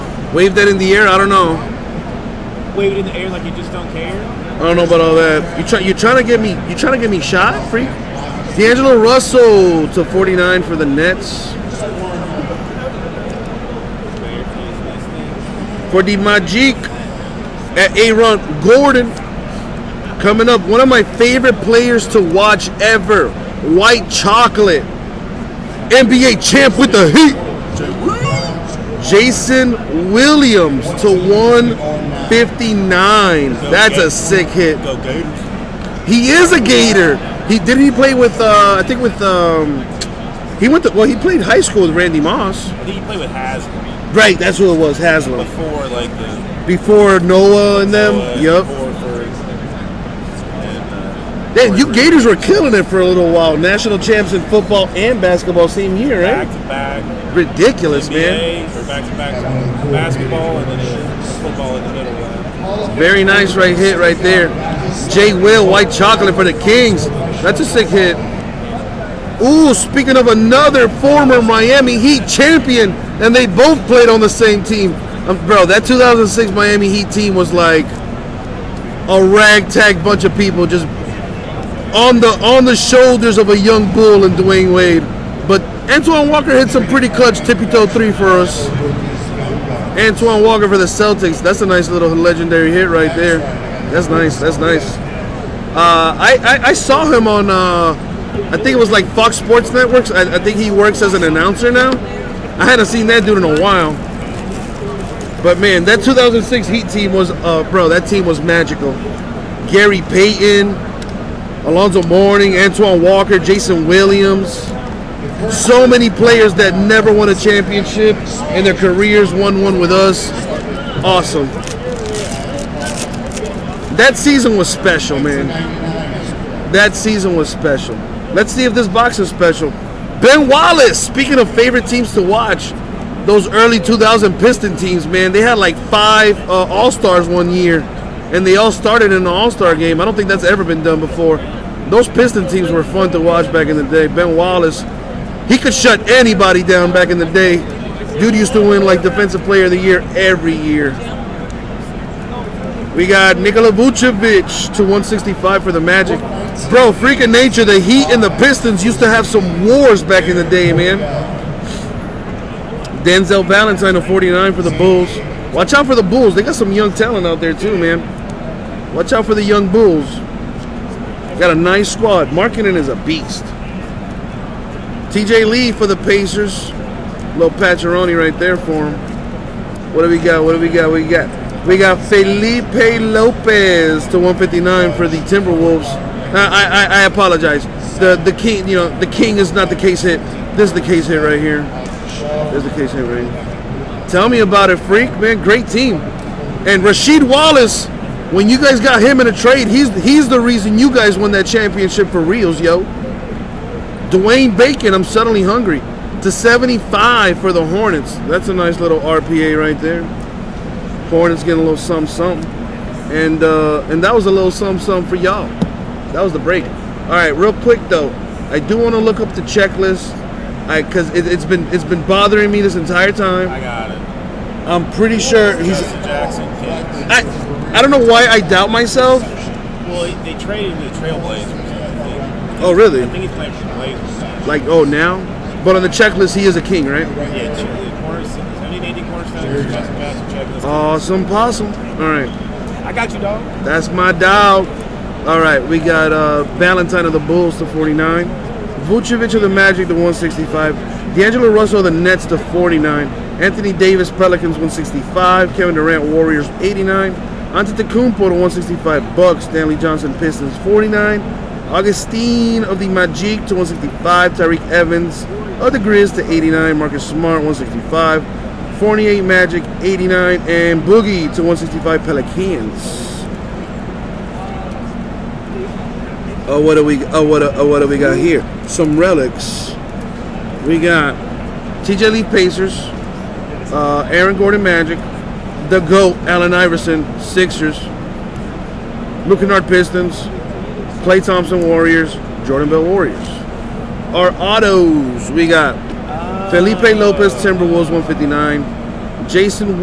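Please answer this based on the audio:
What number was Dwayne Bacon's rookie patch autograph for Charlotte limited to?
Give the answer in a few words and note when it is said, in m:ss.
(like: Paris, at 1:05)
75, at 3:26.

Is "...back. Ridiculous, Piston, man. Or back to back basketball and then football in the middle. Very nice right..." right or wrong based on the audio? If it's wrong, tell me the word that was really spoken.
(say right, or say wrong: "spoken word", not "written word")
wrong: "NBA", not "Piston".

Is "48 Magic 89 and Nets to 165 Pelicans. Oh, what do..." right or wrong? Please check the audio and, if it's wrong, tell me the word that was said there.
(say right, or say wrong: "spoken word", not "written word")
wrong: "Boogie", not "Nets".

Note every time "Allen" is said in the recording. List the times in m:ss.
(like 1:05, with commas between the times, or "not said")
4:46.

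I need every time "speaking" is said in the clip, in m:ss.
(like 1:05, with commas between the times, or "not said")
1:09, 2:11.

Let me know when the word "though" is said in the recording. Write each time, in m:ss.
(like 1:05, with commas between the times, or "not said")
3:37.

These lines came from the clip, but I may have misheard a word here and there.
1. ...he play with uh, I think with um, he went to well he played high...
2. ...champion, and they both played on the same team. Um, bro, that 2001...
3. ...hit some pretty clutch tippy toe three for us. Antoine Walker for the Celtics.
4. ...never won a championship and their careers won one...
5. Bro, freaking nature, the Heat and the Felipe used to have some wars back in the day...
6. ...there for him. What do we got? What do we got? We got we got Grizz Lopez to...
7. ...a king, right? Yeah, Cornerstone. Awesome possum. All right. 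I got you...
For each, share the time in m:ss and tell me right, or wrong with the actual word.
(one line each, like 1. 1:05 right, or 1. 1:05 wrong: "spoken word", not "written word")
1. 0:37 right
2. 1:12 wrong: "2006", not "2001"
3. 1:26 right
4. 1:56 right
5. 2:36 wrong: "Pistons", not "Felipe"
6. 2:58 wrong: "Felipe", not "Grizz"
7. 3:56 right.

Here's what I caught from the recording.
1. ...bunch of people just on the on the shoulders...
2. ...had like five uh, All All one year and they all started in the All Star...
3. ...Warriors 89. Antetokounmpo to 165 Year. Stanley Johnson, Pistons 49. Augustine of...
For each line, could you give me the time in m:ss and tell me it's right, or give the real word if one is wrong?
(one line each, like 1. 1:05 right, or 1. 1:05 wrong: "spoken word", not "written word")
1. 1:20 right
2. 2:15 wrong: "Stars", not "All"
3. 4:16 wrong: "Bucks", not "Year".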